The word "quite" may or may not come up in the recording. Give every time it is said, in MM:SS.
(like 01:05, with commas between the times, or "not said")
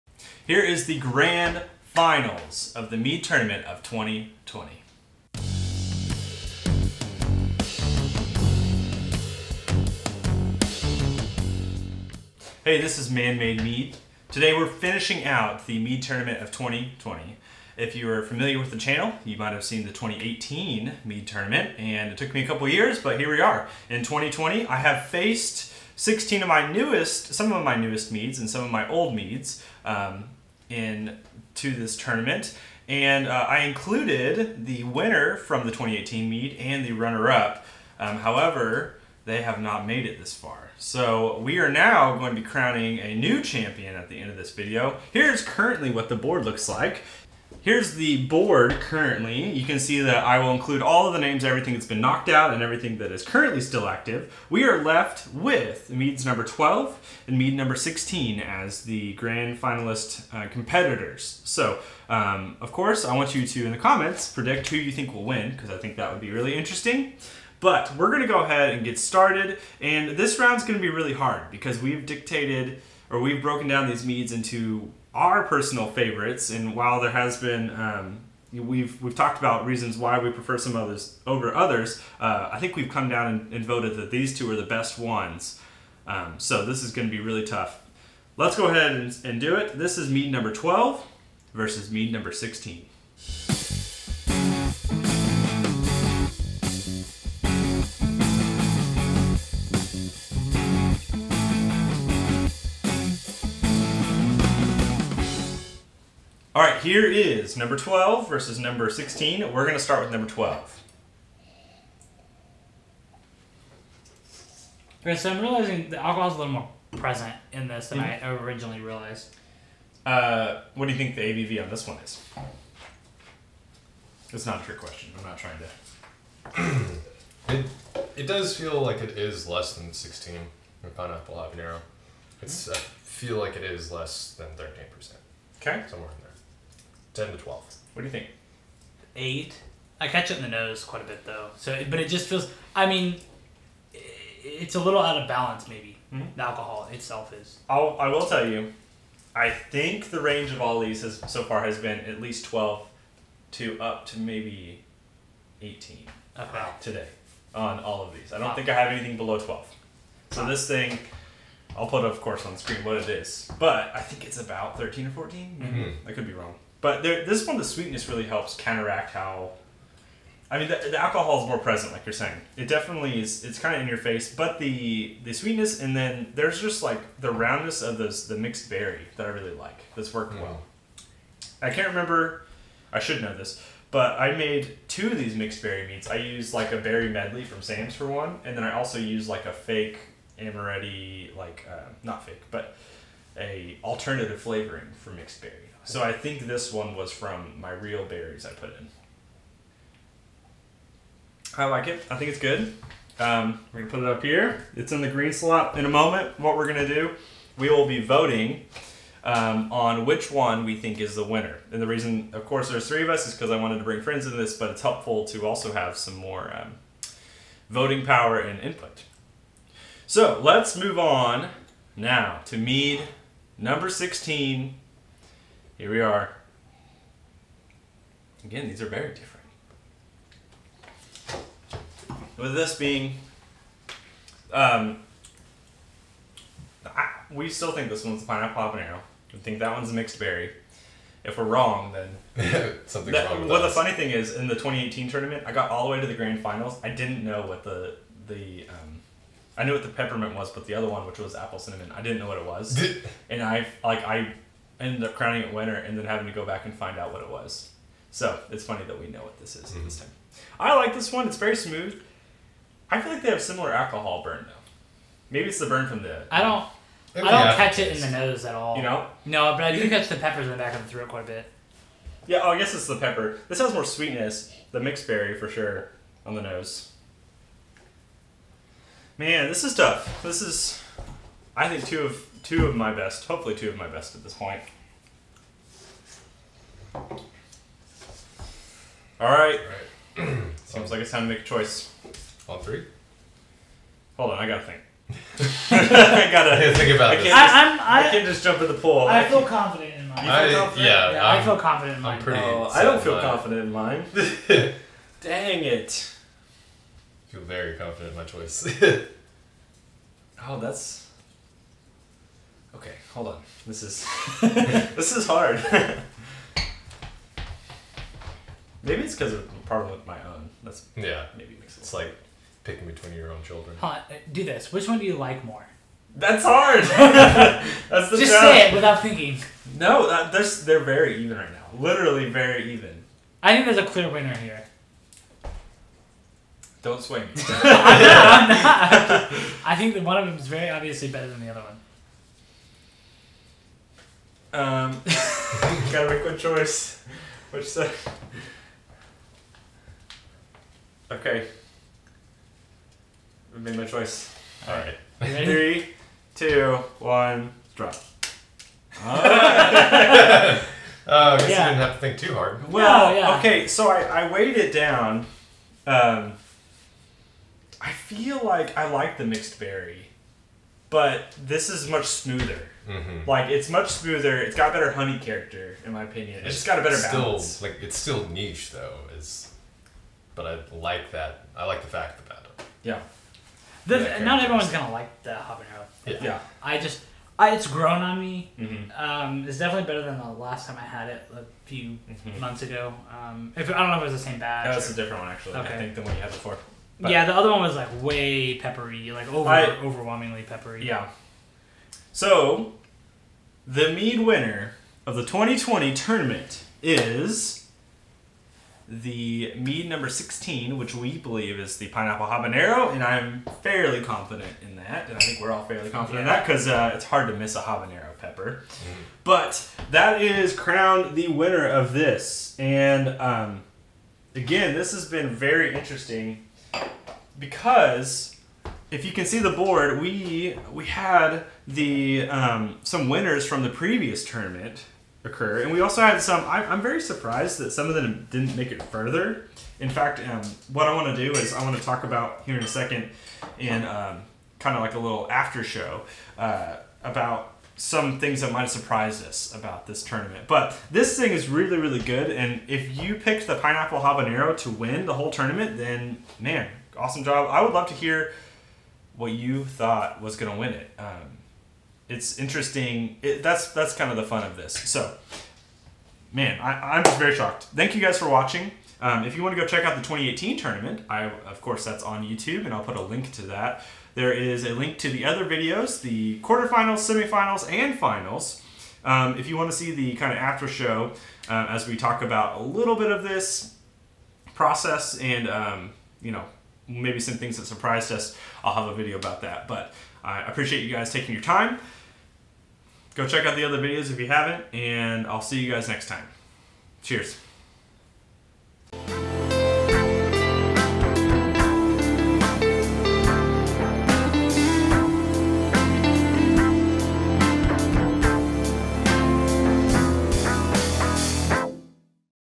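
02:20, 04:31.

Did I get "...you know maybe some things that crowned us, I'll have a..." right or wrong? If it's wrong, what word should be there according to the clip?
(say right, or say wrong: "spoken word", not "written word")
wrong: "surprised", not "crowned".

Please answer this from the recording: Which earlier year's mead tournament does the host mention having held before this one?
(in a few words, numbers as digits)
2018.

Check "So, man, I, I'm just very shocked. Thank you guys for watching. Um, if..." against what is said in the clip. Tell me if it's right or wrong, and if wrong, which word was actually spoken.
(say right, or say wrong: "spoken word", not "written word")
right.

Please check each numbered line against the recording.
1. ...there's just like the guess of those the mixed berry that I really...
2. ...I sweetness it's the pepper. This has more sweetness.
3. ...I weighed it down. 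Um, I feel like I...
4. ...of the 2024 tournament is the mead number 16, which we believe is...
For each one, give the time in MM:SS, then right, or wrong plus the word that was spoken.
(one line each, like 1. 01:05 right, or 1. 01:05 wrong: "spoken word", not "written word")
1. 02:56 wrong: "roundness", not "guess"
2. 04:32 wrong: "guess", not "sweetness"
3. 06:04 right
4. 06:45 wrong: "2020", not "2024".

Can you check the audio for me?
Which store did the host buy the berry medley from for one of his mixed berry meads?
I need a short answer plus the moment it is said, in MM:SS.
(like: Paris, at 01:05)
Sam's, at 03:07.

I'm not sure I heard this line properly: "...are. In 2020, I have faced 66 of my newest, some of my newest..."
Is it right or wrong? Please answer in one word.
wrong.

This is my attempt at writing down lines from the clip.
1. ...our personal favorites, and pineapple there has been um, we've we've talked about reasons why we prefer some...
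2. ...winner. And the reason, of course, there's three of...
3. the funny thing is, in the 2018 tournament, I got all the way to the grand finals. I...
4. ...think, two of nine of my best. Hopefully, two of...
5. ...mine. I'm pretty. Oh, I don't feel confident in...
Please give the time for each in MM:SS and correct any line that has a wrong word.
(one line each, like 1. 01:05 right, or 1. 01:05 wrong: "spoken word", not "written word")
1. 01:15 wrong: "while", not "pineapple"
2. 03:31 right
3. 04:03 right
4. 04:41 wrong: "two", not "nine"
5. 05:02 right.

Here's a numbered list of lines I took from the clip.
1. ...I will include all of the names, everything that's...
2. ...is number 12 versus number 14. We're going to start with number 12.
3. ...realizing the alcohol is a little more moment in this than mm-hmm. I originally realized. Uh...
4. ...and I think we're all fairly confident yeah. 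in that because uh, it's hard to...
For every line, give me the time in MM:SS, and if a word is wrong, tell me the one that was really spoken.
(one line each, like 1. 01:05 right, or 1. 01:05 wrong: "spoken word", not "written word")
1. 00:50 right
2. 01:47 wrong: "16", not "14"
3. 01:55 wrong: "present", not "moment"
4. 06:55 right.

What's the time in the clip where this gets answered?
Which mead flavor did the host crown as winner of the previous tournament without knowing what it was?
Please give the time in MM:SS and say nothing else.
04:11.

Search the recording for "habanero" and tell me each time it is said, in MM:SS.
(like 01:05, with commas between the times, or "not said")
02:11, 03:58, 06:25, 06:52, 06:57, 07:33.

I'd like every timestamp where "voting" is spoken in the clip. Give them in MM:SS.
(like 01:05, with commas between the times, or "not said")
03:28, 03:37.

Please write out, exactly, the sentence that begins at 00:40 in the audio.
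So we are now going to be crowning a new champion at the end of this video.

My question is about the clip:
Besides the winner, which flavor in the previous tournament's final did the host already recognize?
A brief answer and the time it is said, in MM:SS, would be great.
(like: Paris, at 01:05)
Peppermint, at 04:09.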